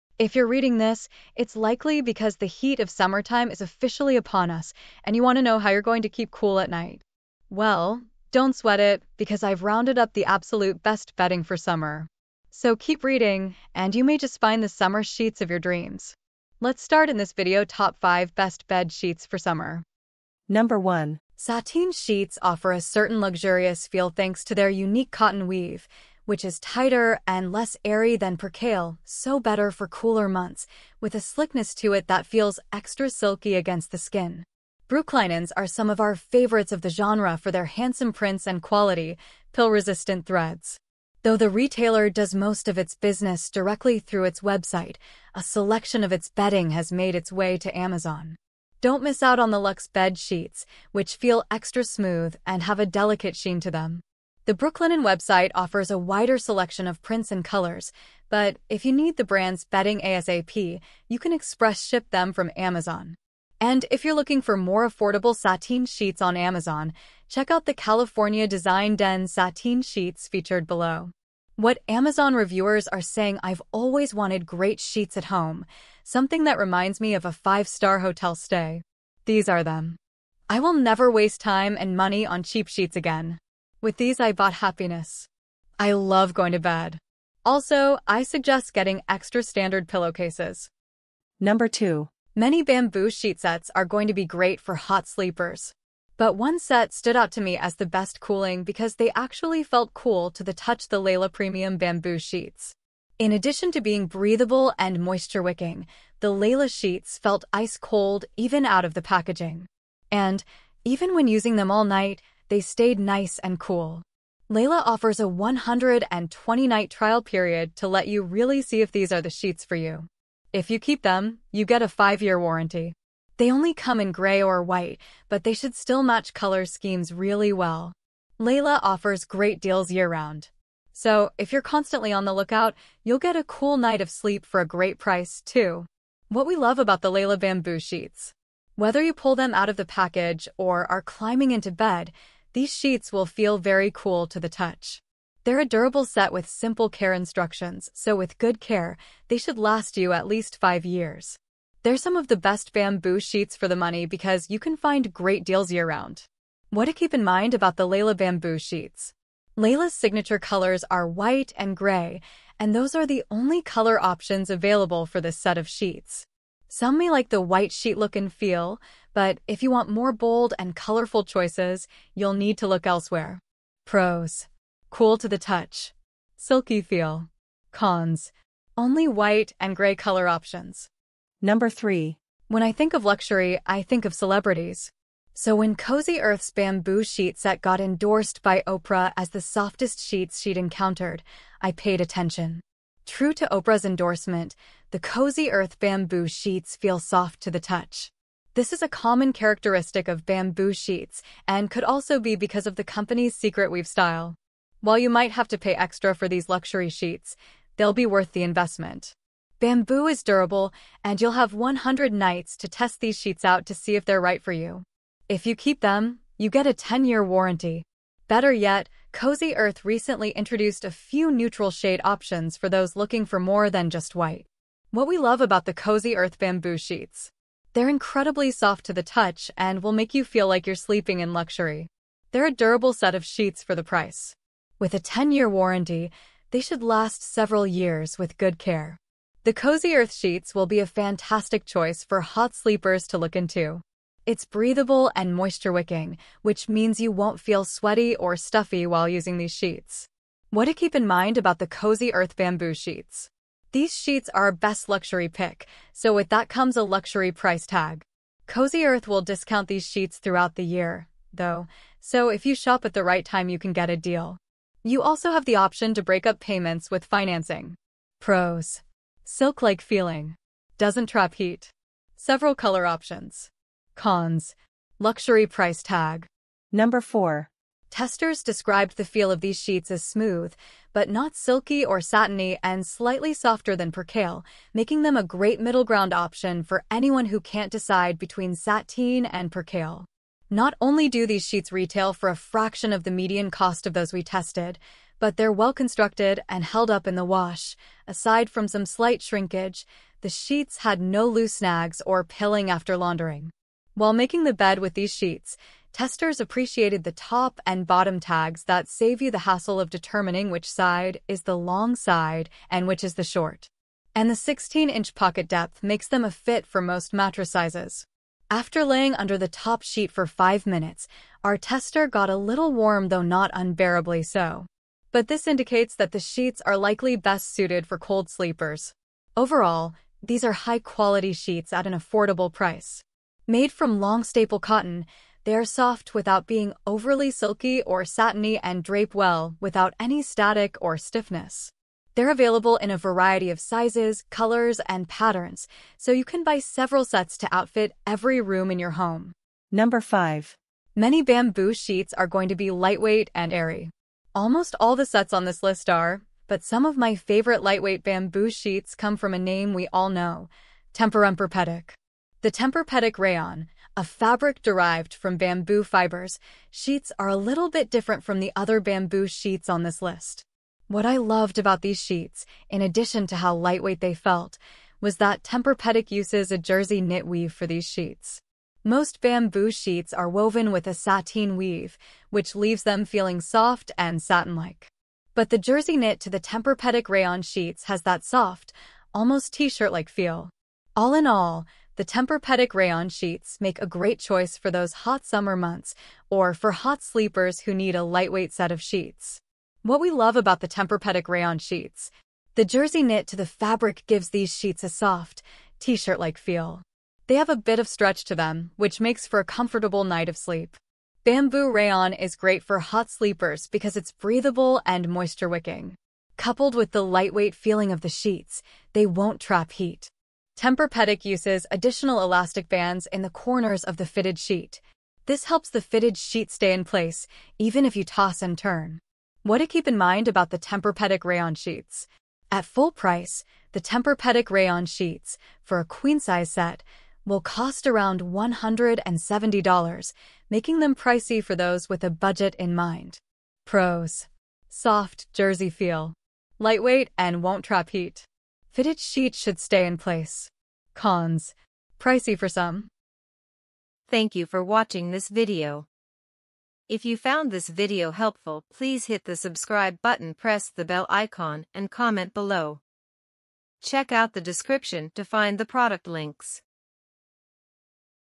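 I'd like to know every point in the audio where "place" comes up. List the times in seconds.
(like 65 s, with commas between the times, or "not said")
426 s, 449 s.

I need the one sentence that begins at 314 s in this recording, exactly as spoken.
And the 16-inch pocket depth makes them a fit for most mattress sizes.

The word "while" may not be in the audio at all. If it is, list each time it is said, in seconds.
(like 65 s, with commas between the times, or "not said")
204 s, 248 s, 303 s.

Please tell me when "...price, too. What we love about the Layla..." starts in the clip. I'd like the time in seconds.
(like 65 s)
134 s.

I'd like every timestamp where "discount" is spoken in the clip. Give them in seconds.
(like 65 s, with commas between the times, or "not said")
259 s.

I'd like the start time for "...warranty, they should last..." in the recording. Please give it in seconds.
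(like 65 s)
235 s.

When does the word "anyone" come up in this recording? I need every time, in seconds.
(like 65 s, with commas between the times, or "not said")
286 s.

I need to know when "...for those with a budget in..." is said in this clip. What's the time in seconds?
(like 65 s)
441 s.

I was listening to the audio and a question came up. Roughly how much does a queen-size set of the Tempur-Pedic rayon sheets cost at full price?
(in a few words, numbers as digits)
$170.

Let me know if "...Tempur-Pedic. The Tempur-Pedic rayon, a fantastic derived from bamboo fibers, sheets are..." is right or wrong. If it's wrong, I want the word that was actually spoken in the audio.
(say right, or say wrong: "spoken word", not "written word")
wrong: "fabric", not "fantastic".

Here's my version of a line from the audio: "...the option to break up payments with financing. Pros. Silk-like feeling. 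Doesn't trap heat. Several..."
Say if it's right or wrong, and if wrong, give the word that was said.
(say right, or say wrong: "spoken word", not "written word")
right.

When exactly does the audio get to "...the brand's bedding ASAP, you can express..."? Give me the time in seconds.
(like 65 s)
59 s.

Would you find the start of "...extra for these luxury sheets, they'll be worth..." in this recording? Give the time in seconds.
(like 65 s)
205 s.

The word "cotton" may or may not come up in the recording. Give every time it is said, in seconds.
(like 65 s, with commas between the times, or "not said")
25 s, 334 s.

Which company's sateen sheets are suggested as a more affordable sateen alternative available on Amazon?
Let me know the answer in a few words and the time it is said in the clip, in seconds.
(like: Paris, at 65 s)
California Design Den, at 67 s.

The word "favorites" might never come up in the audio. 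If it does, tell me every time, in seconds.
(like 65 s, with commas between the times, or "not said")
36 s, 357 s.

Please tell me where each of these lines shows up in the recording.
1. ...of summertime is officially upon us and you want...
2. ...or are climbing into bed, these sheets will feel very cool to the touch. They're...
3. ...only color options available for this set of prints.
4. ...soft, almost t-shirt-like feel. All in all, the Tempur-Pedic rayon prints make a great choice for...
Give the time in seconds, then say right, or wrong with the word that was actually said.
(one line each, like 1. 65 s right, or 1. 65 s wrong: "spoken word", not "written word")
1. 2 s right
2. 140 s right
3. 163 s wrong: "sheets", not "prints"
4. 388 s wrong: "sheets", not "prints".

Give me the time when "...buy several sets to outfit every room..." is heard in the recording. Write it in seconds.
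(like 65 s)
346 s.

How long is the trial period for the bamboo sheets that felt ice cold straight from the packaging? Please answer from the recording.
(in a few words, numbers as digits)
120.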